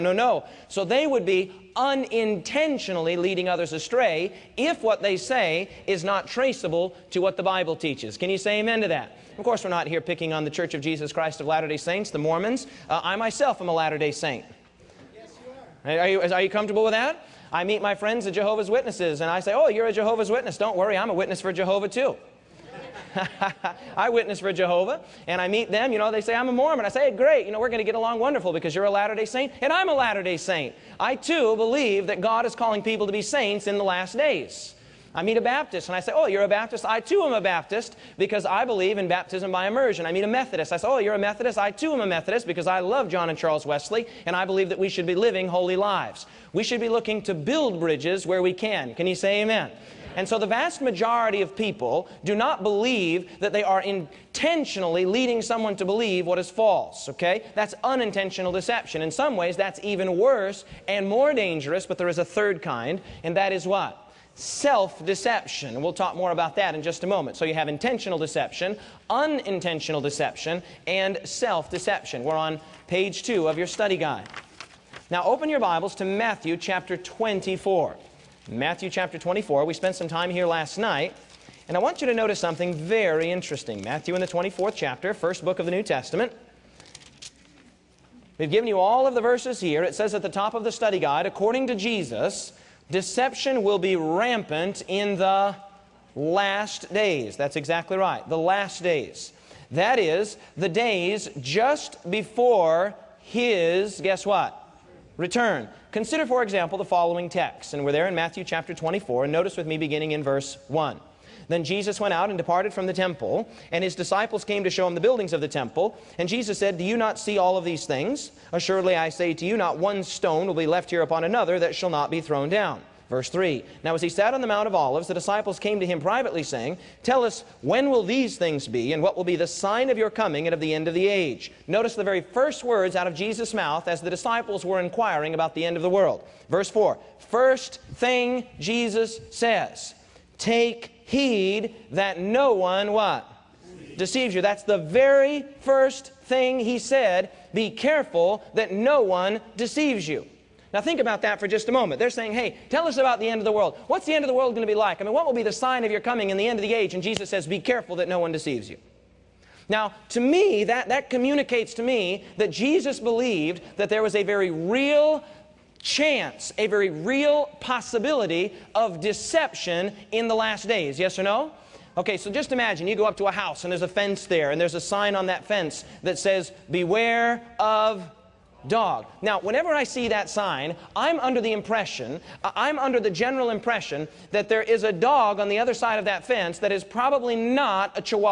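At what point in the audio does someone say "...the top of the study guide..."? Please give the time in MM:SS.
01:30.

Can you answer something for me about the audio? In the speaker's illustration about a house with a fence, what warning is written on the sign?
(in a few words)
Beware of dog.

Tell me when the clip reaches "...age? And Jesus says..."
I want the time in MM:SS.
02:36.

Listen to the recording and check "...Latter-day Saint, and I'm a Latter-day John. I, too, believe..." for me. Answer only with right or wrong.
wrong.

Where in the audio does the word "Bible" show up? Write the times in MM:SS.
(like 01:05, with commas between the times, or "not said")
00:07, 01:15.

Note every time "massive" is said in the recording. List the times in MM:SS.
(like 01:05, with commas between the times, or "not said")
not said.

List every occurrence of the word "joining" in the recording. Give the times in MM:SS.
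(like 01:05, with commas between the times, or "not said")
not said.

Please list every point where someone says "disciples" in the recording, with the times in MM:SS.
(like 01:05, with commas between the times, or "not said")
01:53, 02:05, 02:14.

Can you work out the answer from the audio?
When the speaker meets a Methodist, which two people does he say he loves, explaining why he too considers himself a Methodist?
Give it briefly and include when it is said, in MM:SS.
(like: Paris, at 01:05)
John and Charles Wesley, at 00:43.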